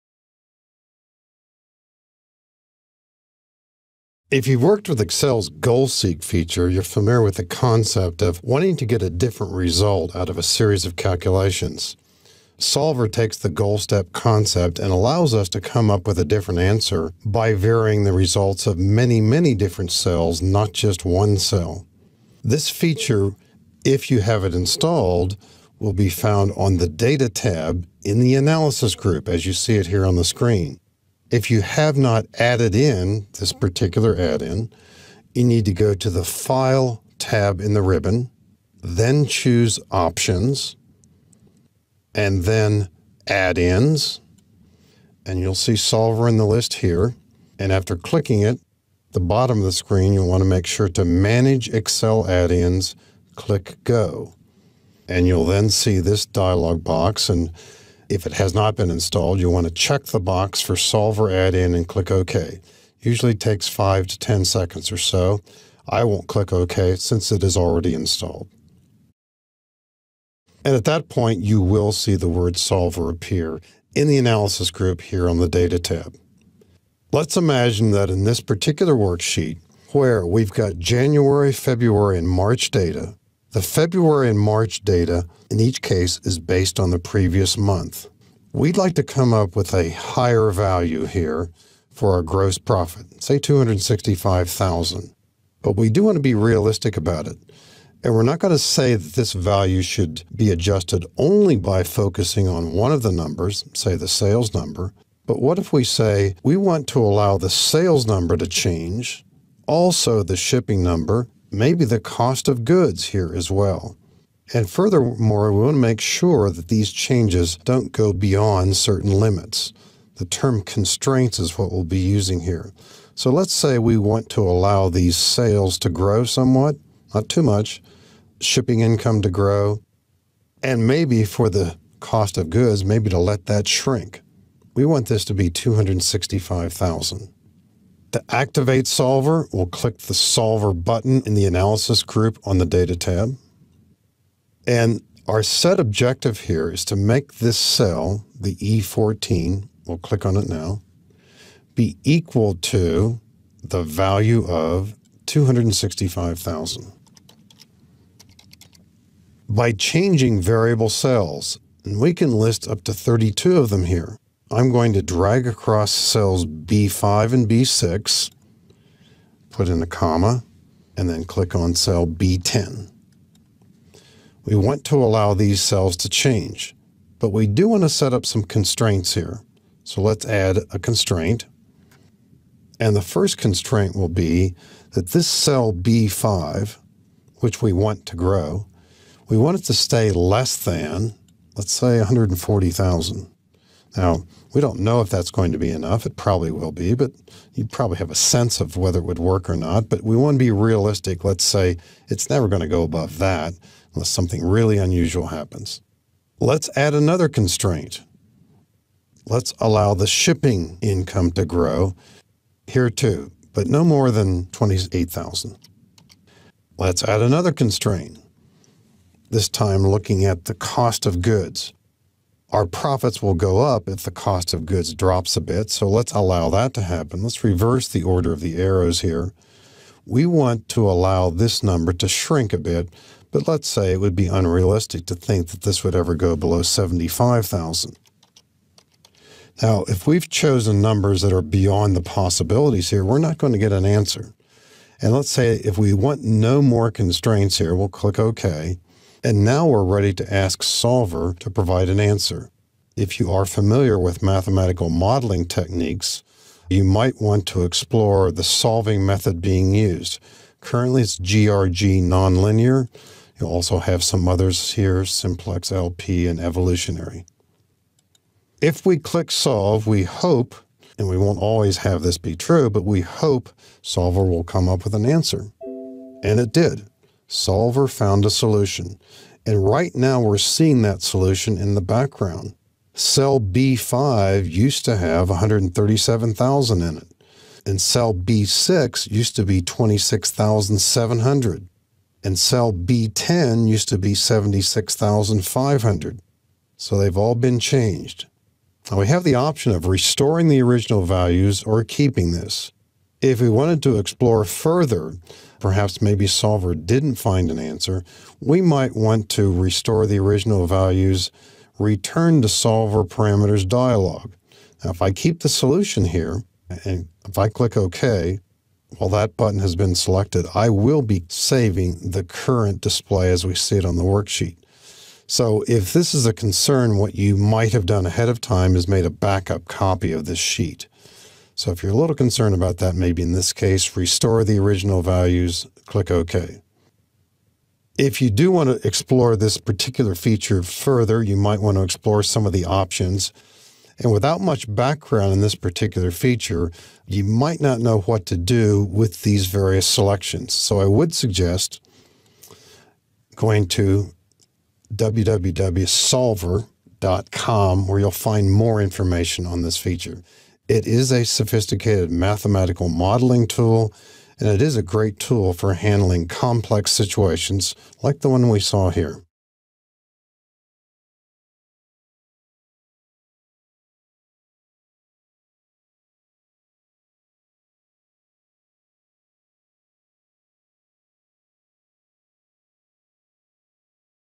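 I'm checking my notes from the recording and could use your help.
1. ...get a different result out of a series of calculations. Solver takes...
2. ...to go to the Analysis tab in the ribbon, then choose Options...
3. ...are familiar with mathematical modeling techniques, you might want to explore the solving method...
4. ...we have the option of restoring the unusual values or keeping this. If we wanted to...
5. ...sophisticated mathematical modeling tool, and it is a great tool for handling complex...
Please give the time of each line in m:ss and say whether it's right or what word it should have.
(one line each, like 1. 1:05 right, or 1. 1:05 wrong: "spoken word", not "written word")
1. 0:08 right
2. 0:35 wrong: "File", not "Analysis"
3. 4:13 right
4. 4:58 wrong: "original", not "unusual"
5. 6:01 right.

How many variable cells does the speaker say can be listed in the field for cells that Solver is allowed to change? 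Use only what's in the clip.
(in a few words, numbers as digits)
32.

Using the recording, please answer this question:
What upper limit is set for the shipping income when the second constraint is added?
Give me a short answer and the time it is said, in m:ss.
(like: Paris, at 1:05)
28,000, at 3:34.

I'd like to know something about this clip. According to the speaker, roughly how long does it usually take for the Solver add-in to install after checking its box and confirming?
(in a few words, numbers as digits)
5 to 10 seconds.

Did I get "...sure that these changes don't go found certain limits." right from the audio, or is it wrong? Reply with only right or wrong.
wrong.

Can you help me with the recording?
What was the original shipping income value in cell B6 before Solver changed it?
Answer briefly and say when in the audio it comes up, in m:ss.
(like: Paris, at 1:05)
26,700, at 4:49.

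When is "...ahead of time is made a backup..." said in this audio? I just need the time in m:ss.
5:28.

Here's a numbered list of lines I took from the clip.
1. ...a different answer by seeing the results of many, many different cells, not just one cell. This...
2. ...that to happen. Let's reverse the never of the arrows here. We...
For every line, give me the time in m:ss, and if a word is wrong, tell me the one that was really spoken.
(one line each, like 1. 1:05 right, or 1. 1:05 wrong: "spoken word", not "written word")
1. 0:16 wrong: "varying", not "seeing"
2. 3:46 wrong: "order", not "never".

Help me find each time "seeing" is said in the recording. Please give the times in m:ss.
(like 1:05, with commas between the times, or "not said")
4:40.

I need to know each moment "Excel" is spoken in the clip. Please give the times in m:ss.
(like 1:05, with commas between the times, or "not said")
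0:05, 0:51.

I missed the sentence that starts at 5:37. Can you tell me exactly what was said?
If you do want to explore this particular feature further, you might want to explore some of the options.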